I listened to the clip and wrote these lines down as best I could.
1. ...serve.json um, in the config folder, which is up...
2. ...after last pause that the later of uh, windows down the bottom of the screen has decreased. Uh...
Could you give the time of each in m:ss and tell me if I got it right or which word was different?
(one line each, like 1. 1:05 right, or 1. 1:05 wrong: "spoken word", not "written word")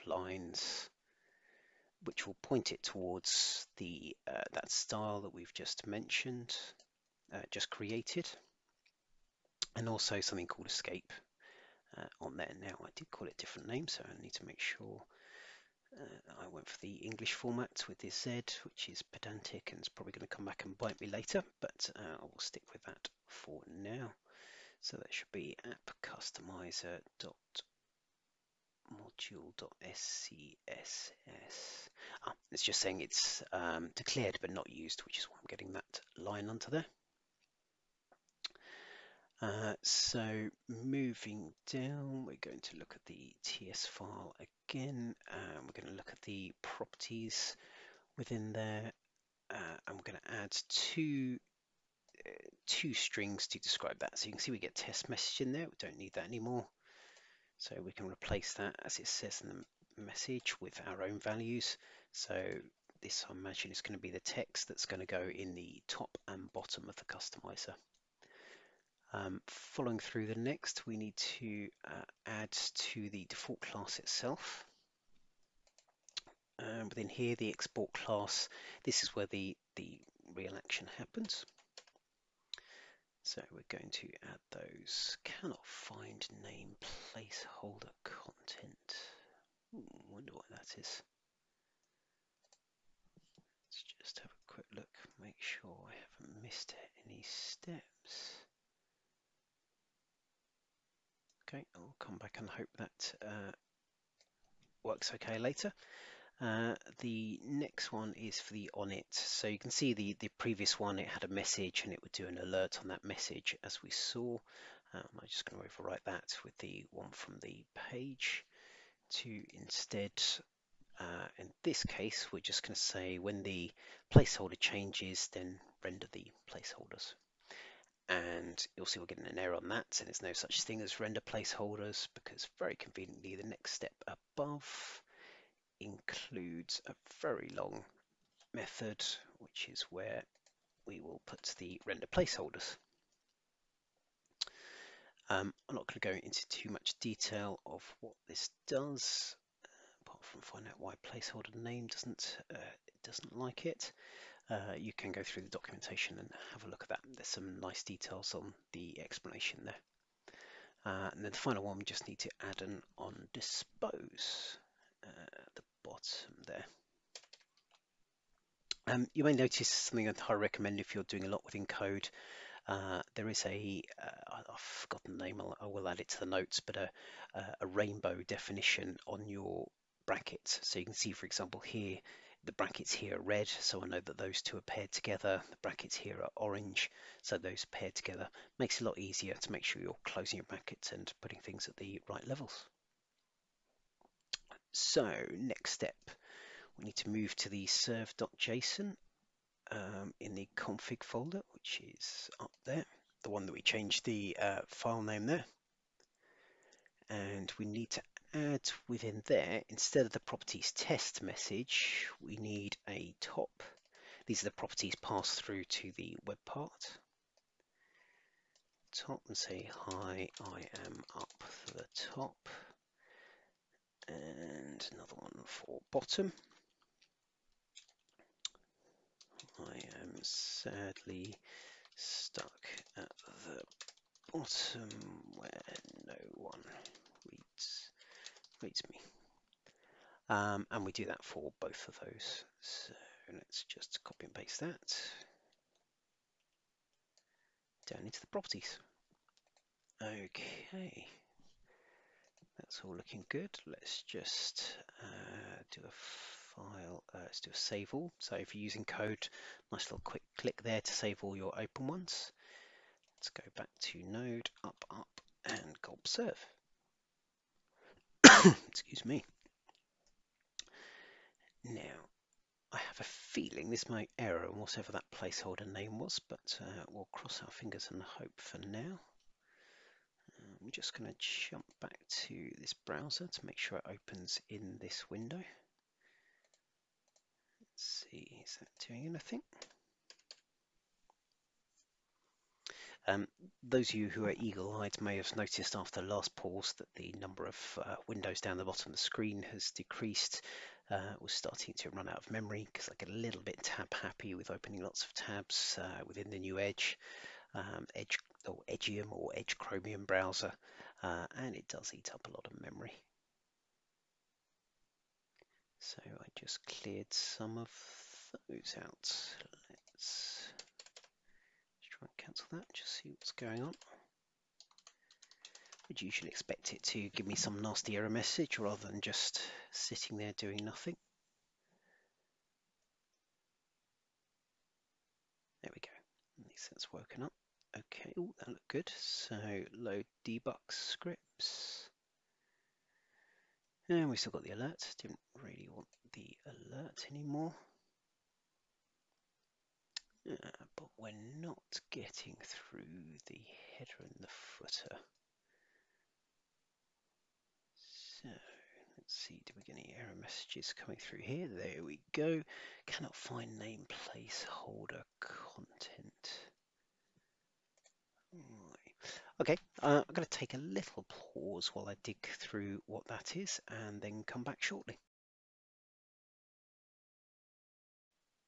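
1. 3:17 right
2. 4:55 wrong: "number", not "later".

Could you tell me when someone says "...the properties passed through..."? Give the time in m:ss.
3:34.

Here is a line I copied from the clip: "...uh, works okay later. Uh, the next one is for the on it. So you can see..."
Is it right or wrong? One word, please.
right.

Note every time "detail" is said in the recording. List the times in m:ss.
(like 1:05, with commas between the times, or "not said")
2:27, 2:37.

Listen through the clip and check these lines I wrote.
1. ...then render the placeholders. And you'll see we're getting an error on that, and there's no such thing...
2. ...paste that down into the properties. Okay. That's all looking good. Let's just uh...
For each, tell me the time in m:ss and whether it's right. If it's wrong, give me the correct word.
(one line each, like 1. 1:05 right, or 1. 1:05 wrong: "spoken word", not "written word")
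1. 2:05 right
2. 4:04 right.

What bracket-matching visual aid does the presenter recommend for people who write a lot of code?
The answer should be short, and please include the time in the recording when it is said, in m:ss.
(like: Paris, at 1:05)
rainbow definition, at 2:57.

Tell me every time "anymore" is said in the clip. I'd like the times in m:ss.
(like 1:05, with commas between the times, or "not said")
0:56, 5:47.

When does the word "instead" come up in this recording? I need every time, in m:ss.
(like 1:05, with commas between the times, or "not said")
1:59, 3:29.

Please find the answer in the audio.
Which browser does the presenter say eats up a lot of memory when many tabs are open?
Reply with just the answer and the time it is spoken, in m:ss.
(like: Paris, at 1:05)
Edge Chromium, at 5:09.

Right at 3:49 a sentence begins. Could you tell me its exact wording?
I am sadly stuck at the bottom where no one reads, reads me.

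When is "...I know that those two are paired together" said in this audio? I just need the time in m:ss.
3:03.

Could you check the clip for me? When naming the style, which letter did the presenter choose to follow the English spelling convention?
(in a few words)
Z.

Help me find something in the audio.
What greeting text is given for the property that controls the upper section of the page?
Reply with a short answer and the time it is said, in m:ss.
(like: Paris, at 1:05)
Hi, I am up the top, at 3:39.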